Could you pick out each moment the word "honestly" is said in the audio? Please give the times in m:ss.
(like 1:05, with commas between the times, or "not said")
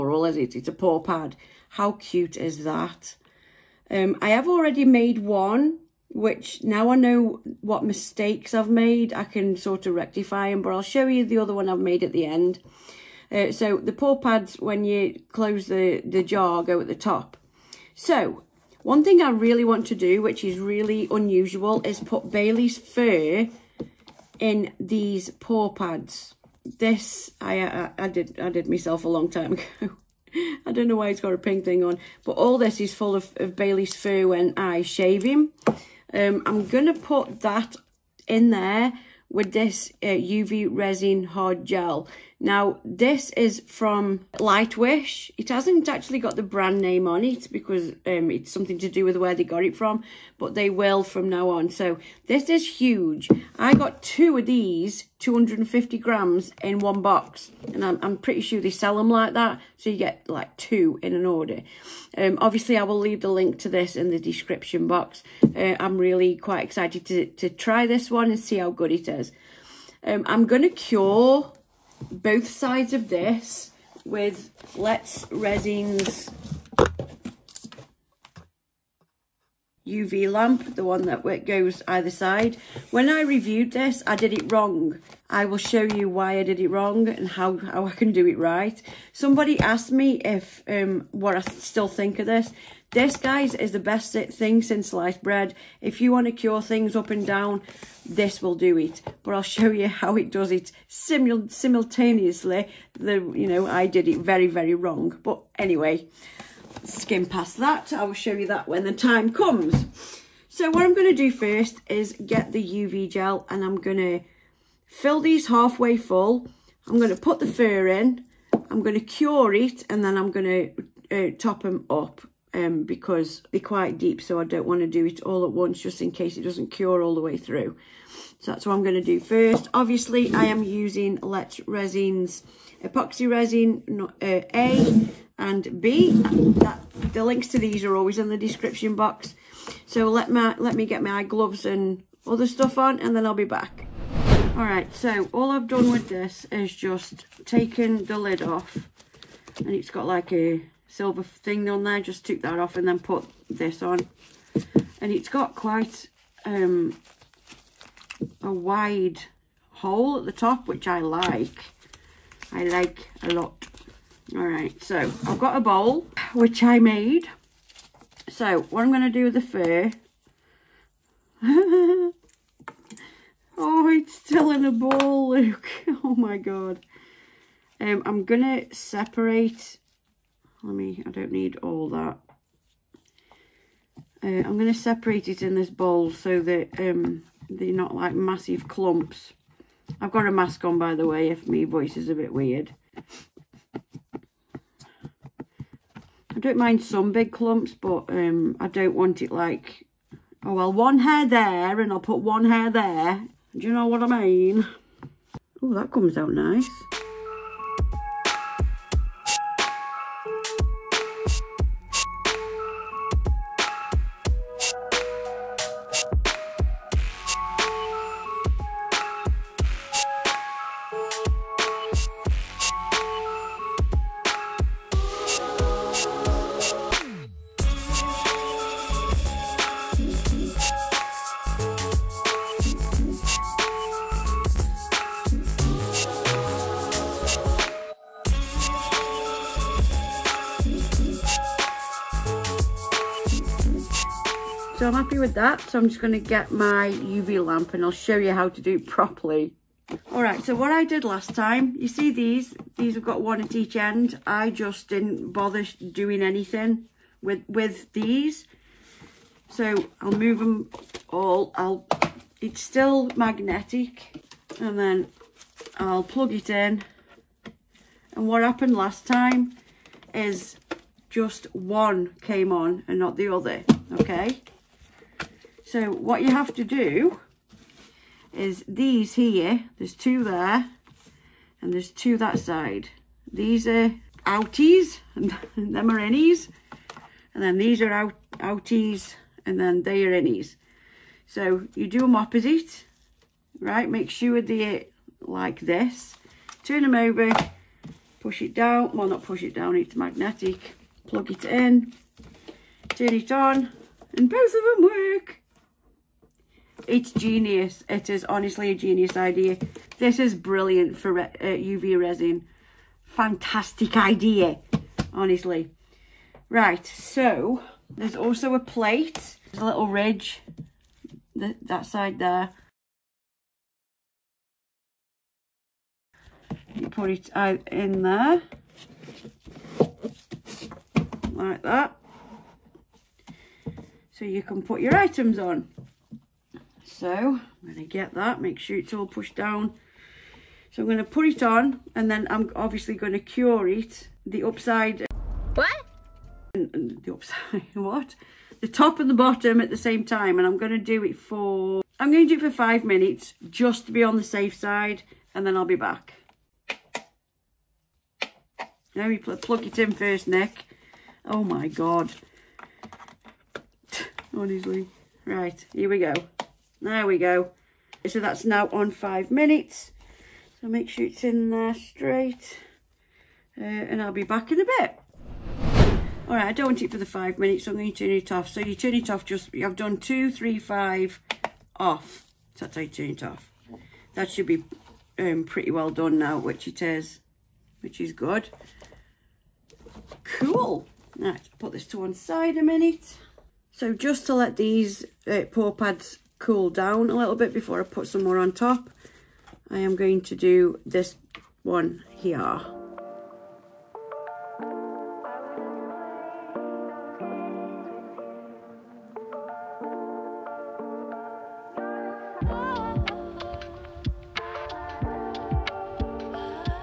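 5:08, 5:15, 6:04.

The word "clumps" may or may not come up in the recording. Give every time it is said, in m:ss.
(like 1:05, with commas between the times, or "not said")
3:08, 3:17.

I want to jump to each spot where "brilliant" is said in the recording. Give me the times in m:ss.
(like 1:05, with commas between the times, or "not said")
5:10.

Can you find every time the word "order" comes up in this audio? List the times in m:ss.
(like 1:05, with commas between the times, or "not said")
1:01.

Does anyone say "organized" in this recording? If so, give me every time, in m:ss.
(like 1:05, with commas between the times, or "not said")
not said.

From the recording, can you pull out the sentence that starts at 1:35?
If you want to cure things up and down, this will do it.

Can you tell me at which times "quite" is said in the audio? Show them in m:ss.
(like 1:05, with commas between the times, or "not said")
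1:06, 2:03, 2:35.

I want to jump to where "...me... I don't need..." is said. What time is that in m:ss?
3:00.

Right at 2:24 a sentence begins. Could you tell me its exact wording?
Alright, so all I've done with this is just taken the lid off and it's got like a silver thing on there.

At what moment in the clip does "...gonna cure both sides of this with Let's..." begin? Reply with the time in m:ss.
1:10.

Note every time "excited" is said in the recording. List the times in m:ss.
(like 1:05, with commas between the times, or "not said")
1:06.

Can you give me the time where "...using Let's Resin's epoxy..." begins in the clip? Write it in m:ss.
2:10.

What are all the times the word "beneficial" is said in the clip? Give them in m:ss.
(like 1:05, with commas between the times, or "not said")
not said.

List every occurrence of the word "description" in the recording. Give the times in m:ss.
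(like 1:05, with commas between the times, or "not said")
1:04, 2:18.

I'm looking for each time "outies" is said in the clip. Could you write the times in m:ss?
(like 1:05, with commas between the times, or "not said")
4:44, 4:48.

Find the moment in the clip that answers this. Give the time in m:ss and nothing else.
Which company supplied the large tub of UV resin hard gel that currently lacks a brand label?
0:44.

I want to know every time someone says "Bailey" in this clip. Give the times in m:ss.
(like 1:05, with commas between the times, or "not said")
0:22, 0:33.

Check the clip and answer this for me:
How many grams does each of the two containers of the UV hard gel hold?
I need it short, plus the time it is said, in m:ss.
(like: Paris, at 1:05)
250 grams, at 0:55.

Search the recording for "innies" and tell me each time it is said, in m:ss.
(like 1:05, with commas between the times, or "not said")
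4:45, 4:50.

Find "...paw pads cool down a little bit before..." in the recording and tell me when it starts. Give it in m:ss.
6:35.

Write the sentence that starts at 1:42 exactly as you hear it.
The, you know, I did it very, very wrong.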